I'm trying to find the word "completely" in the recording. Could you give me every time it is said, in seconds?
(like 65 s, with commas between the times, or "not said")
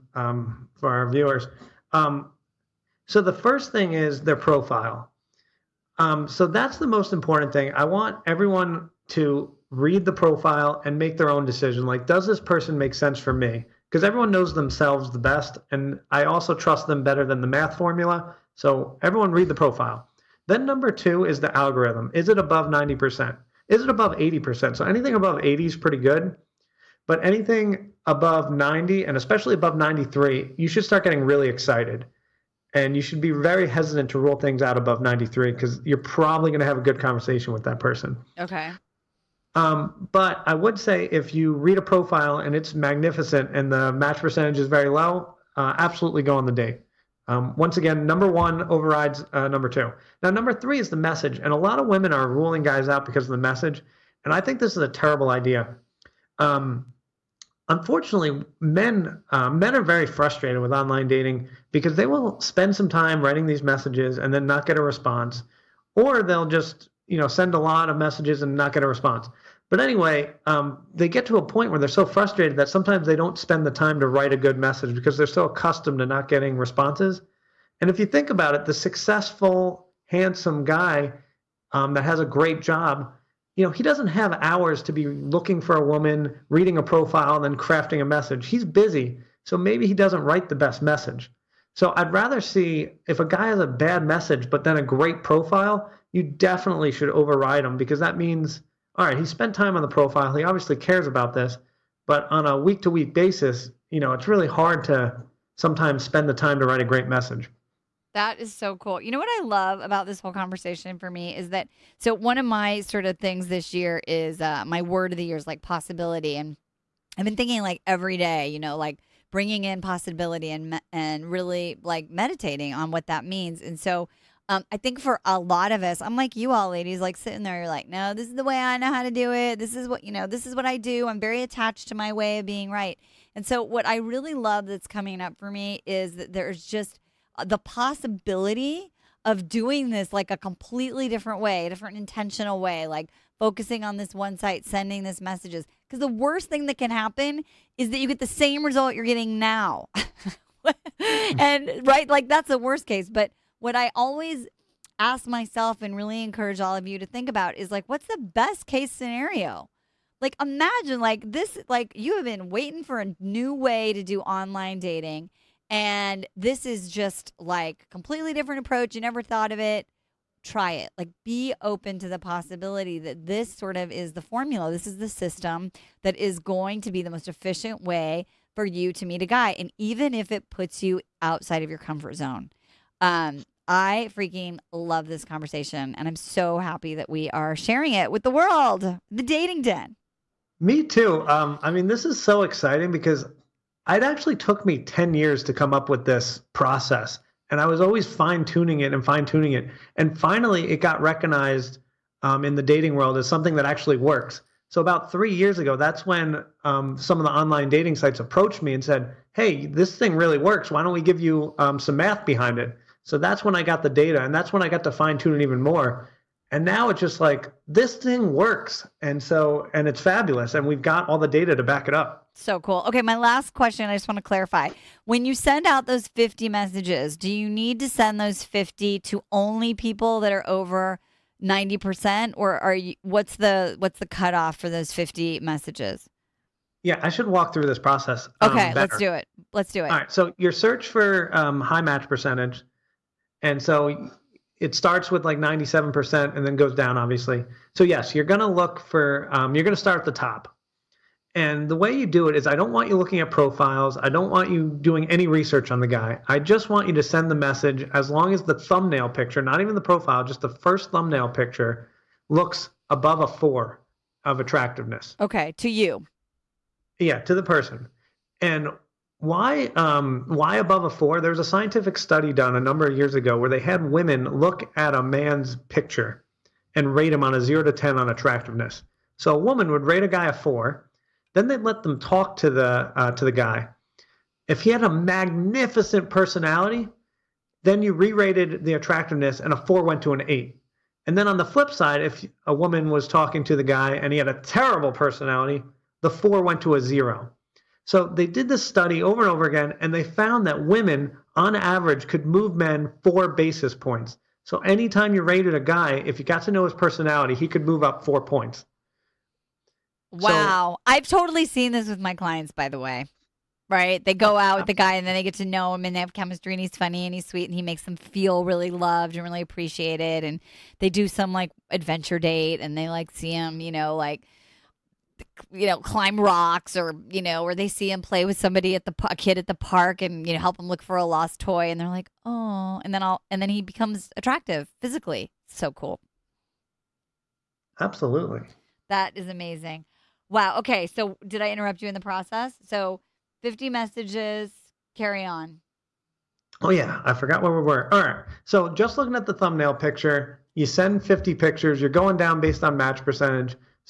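140 s, 167 s.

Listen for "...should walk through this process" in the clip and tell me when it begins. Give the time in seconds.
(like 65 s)
237 s.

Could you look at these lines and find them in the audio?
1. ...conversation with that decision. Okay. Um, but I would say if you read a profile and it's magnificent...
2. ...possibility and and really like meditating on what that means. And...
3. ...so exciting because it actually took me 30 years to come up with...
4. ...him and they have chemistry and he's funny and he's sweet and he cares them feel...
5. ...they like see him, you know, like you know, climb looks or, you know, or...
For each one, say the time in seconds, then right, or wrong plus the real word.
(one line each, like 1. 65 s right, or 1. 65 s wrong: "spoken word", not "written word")
1. 36 s wrong: "person", not "decision"
2. 119 s right
3. 192 s wrong: "10", not "30"
4. 315 s wrong: "makes", not "cares"
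5. 322 s wrong: "rocks", not "looks".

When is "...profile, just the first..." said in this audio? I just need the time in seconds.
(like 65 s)
259 s.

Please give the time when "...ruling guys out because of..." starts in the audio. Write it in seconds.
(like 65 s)
52 s.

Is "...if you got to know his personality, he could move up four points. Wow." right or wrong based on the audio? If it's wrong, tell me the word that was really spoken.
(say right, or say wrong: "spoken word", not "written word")
right.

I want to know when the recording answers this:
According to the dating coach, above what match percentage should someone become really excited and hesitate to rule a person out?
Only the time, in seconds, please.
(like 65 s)
29 s.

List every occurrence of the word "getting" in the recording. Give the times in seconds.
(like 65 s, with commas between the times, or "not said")
31 s, 76 s, 149 s.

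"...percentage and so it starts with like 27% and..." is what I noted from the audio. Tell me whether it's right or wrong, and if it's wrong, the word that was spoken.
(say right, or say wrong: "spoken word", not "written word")
wrong: "97", not "27".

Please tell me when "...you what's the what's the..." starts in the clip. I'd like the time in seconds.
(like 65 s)
232 s.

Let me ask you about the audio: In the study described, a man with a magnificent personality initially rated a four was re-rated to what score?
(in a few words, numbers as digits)
8.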